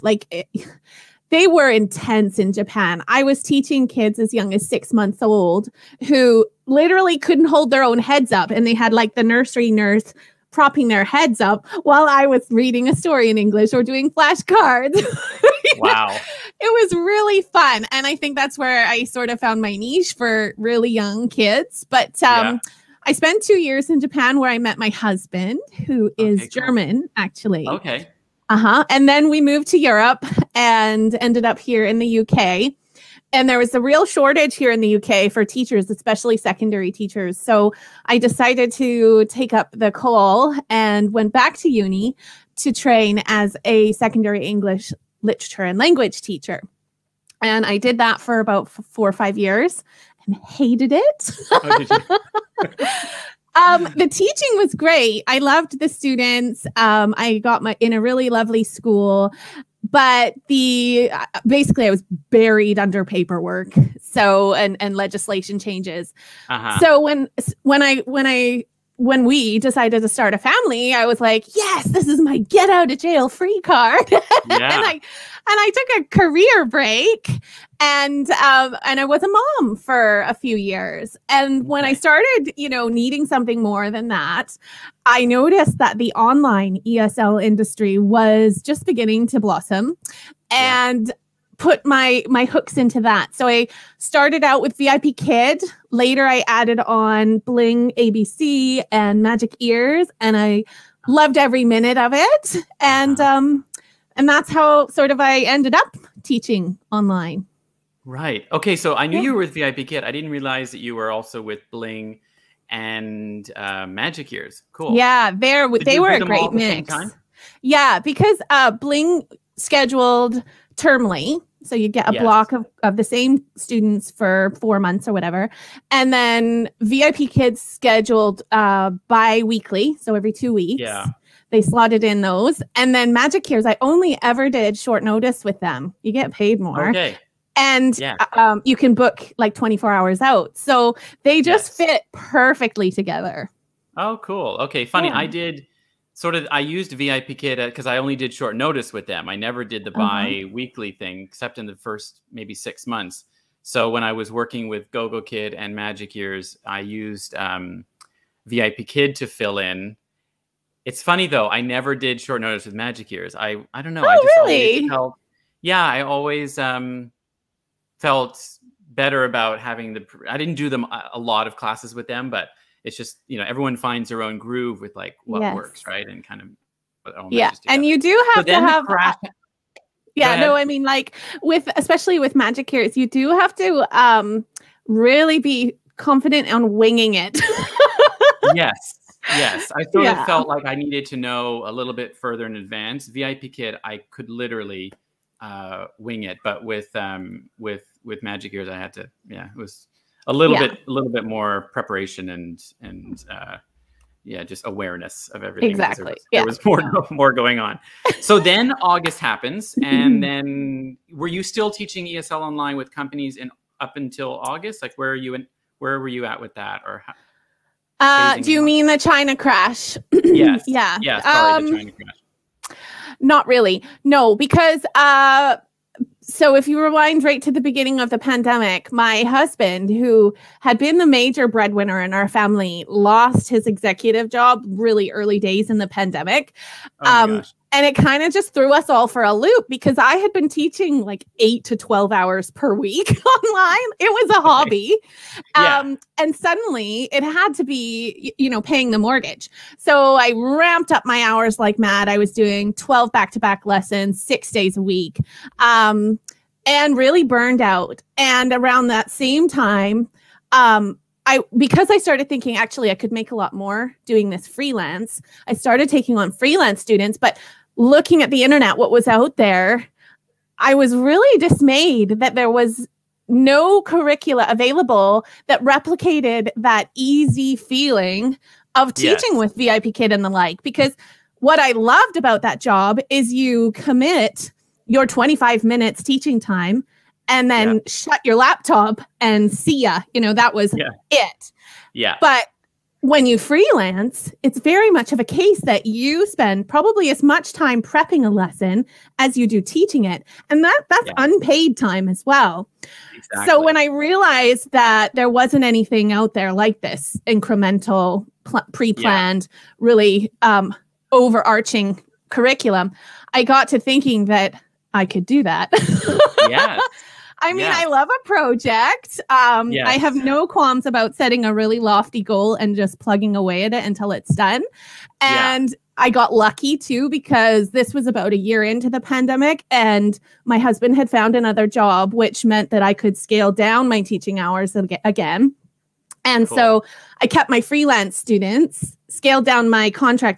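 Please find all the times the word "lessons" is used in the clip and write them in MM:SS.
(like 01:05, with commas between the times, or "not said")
04:13, 04:58.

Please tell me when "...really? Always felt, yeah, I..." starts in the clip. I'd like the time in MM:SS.
02:44.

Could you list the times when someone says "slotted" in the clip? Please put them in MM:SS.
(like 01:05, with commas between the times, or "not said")
02:11.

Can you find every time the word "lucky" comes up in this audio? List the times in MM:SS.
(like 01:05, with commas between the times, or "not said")
05:26.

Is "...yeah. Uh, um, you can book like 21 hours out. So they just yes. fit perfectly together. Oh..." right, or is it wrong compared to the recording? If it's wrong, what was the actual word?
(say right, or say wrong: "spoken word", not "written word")
wrong: "24", not "21".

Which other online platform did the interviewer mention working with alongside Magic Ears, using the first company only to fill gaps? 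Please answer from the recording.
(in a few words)
GoGo Kid.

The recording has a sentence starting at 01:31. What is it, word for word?
put my my hooks into that.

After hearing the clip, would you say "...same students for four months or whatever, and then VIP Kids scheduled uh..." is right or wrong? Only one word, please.
right.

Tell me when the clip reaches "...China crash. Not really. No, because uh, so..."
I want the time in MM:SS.
03:41.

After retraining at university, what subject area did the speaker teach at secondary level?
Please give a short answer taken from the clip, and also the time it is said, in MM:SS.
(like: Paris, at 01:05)
English literature and language, at 00:44.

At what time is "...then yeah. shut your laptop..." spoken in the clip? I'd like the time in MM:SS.
04:47.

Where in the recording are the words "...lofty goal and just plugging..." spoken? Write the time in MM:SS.
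05:21.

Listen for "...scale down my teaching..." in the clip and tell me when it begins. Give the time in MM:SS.
05:33.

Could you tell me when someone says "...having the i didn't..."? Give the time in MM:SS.
02:49.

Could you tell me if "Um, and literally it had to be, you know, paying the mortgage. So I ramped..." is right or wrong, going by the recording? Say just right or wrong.
wrong.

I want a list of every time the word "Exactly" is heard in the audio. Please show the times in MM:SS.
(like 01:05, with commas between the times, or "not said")
03:25, 05:03.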